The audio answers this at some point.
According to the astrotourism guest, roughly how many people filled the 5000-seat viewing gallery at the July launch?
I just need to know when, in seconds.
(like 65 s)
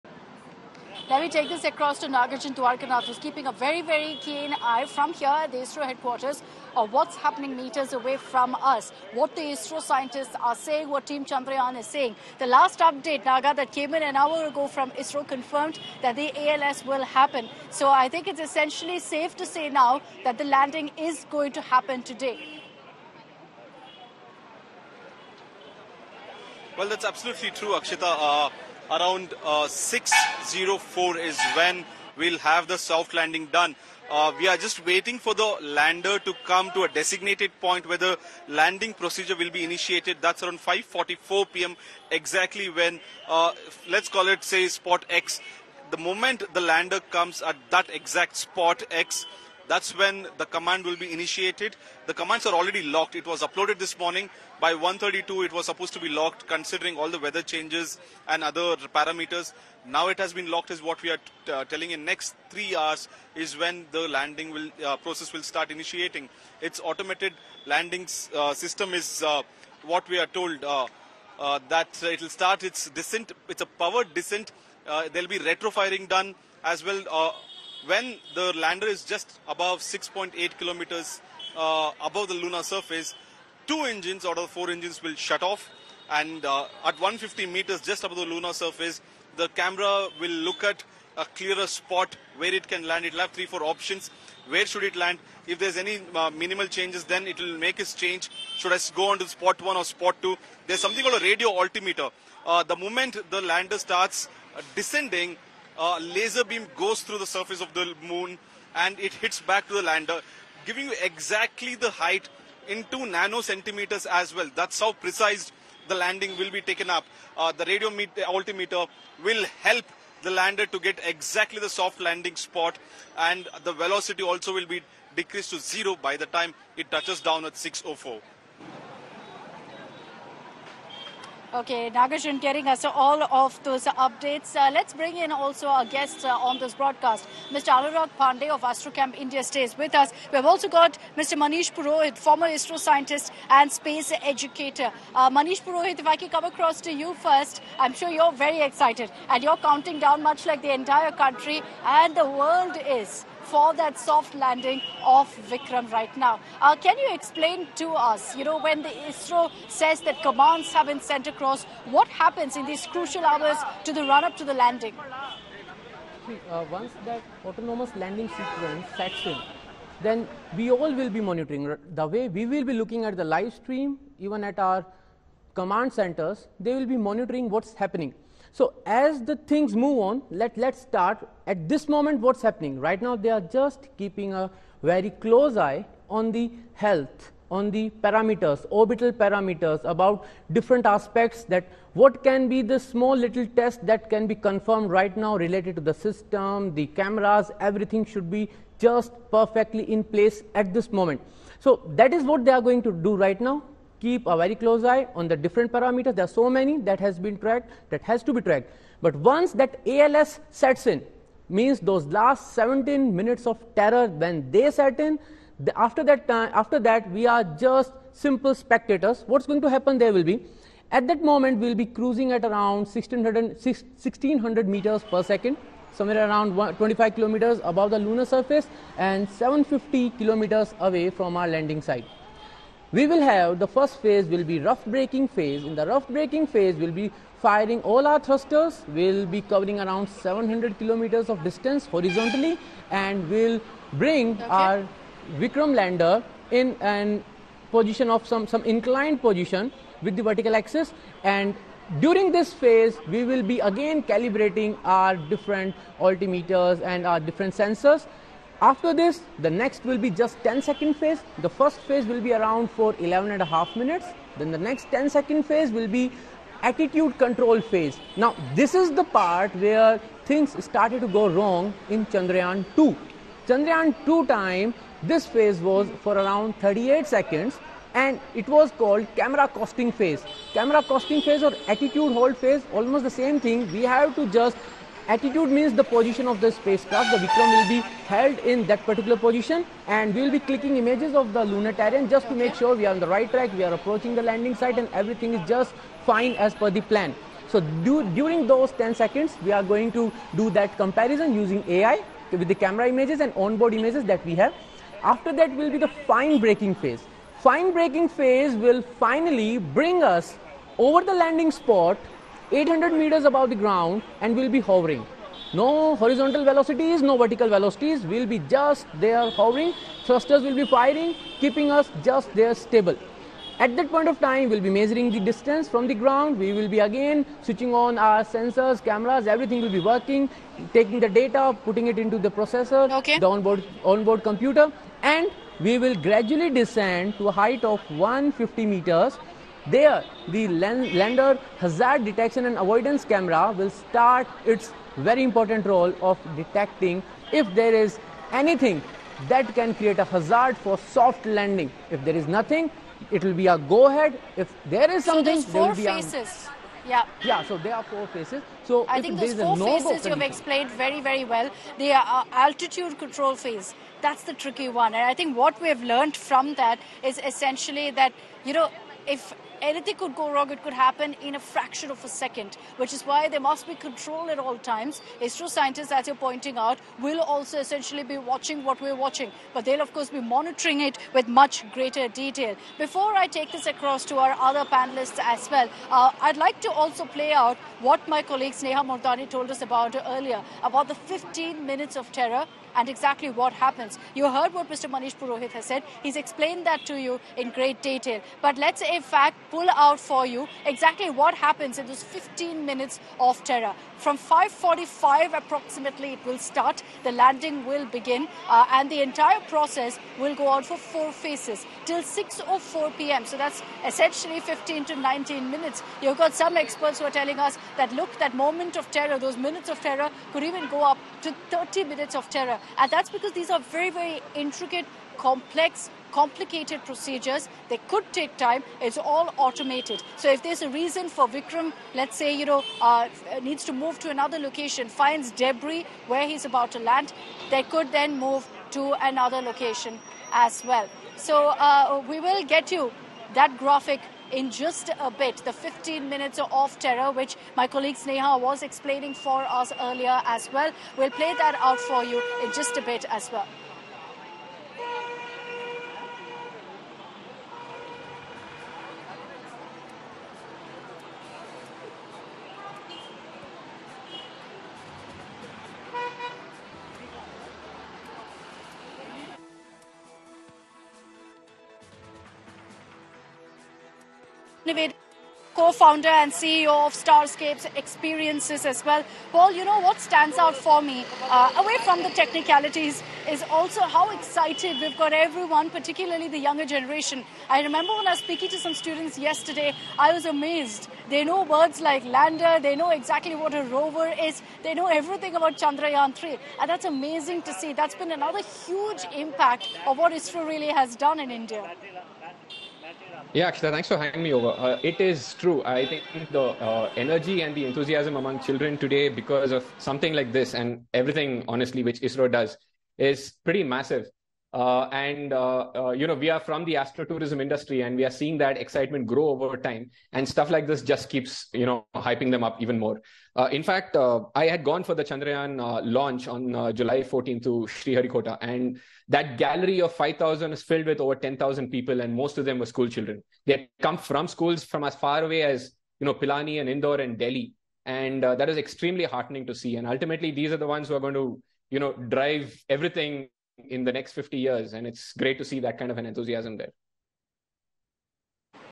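530 s.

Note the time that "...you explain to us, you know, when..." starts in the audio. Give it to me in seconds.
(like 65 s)
156 s.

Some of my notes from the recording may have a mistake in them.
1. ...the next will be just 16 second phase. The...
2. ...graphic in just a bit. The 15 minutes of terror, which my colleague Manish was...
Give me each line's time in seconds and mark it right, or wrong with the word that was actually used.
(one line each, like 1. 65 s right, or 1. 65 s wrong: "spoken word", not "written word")
1. 259 s wrong: "10", not "16"
2. 443 s wrong: "Sneha", not "Manish".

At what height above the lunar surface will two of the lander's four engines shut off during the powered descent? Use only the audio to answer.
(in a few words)
6.8 kilometers.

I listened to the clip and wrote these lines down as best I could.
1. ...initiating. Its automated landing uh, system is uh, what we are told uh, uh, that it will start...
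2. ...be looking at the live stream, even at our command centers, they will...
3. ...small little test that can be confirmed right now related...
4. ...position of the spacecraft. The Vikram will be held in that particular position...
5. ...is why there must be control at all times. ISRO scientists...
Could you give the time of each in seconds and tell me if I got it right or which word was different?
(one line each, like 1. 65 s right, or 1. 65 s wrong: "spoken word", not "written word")
1. 65 s right
2. 172 s right
3. 192 s right
4. 285 s right
5. 372 s right.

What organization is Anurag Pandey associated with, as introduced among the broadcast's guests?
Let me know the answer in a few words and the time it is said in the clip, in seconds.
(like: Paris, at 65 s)
AstroCamp India, at 138 s.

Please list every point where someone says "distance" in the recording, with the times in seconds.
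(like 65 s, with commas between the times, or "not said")
241 s, 325 s.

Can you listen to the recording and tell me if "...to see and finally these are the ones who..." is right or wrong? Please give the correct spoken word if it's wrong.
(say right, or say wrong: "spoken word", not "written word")
wrong: "ultimately", not "finally".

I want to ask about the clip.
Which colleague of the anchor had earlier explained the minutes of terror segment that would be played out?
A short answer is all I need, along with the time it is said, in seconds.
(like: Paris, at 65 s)
Sneha Mordani, at 388 s.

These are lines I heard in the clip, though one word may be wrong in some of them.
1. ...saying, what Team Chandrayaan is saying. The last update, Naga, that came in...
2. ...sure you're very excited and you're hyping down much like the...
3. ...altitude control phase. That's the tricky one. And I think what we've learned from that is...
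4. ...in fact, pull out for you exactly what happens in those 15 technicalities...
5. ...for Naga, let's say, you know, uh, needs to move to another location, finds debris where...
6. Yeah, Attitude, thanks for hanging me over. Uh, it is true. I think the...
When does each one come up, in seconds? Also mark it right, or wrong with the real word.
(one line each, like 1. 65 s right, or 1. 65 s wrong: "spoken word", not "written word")
1. 10 s right
2. 147 s wrong: "counting", not "hyping"
3. 362 s right
4. 398 s wrong: "minutes", not "technicalities"
5. 431 s wrong: "Vikram", not "Naga"
6. 503 s wrong: "Akshita", not "Attitude".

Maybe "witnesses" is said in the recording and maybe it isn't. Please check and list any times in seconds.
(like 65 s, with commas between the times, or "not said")
not said.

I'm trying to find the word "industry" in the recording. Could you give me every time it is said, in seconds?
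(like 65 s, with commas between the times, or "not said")
517 s.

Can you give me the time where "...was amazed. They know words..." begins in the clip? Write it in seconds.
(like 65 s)
490 s.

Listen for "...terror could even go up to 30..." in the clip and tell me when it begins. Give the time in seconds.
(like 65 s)
419 s.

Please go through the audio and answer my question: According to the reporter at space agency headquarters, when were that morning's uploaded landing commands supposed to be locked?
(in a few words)
1.32.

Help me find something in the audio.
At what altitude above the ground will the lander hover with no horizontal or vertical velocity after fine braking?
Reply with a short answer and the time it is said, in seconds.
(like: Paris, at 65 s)
800 meters, at 312 s.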